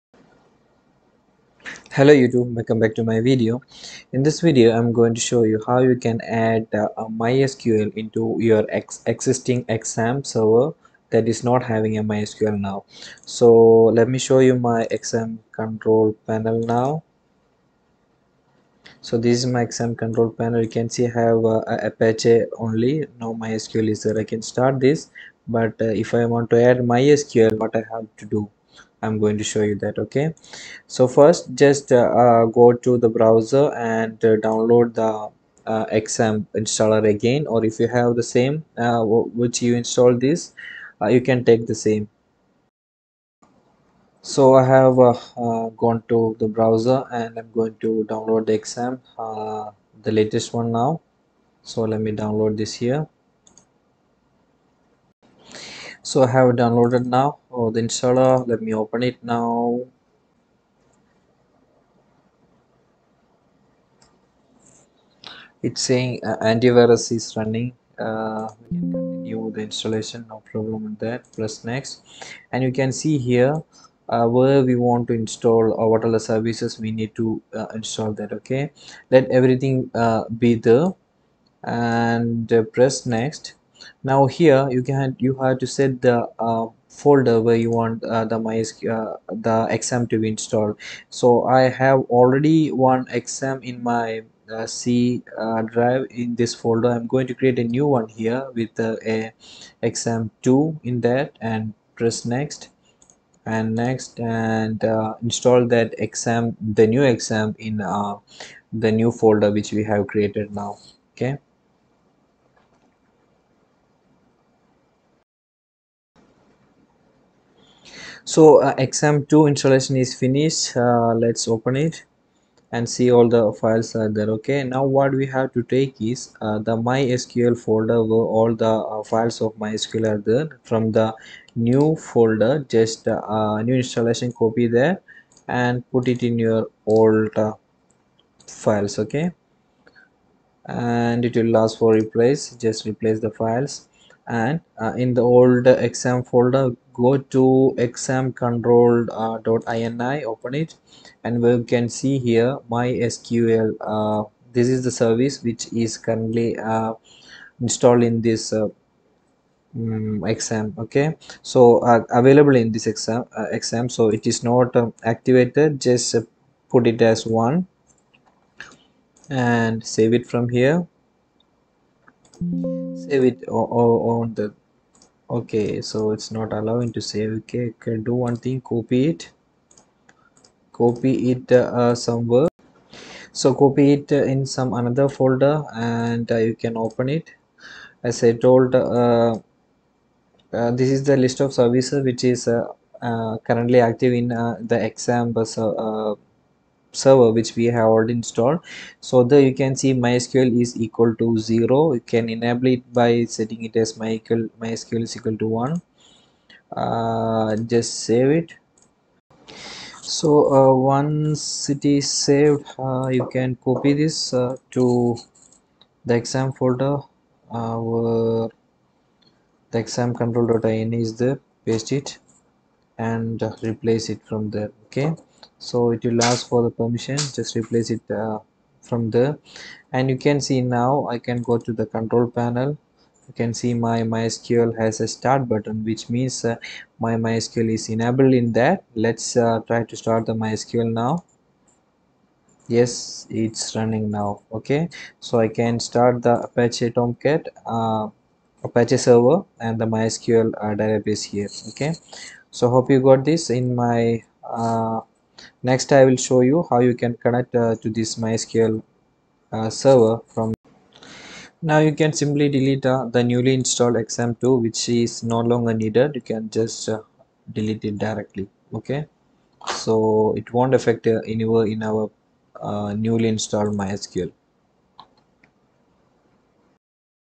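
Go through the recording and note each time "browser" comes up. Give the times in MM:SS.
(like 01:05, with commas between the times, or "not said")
00:33, 00:46.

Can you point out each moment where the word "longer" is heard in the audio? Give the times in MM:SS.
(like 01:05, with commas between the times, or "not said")
04:25.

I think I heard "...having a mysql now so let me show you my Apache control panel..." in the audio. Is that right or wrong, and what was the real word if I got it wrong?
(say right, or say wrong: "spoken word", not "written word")
wrong: "XAMPP", not "Apache".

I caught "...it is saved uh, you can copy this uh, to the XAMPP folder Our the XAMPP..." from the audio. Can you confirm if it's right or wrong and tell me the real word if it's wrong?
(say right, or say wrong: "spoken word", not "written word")
right.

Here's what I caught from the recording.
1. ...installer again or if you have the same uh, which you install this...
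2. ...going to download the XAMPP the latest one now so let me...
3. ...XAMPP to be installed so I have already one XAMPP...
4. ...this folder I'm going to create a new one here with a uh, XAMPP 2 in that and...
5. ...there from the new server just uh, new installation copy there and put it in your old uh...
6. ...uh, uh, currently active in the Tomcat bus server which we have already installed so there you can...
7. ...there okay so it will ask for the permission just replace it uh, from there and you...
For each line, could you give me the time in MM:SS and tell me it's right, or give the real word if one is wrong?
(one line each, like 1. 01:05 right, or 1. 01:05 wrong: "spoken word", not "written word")
1. 00:36 right
2. 00:47 right
3. 01:29 right
4. 01:36 right
5. 02:10 wrong: "folder", not "server"
6. 03:12 wrong: "XAMPP", not "Tomcat"
7. 03:44 right.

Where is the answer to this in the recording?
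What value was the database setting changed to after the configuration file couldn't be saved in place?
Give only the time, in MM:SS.
03:24.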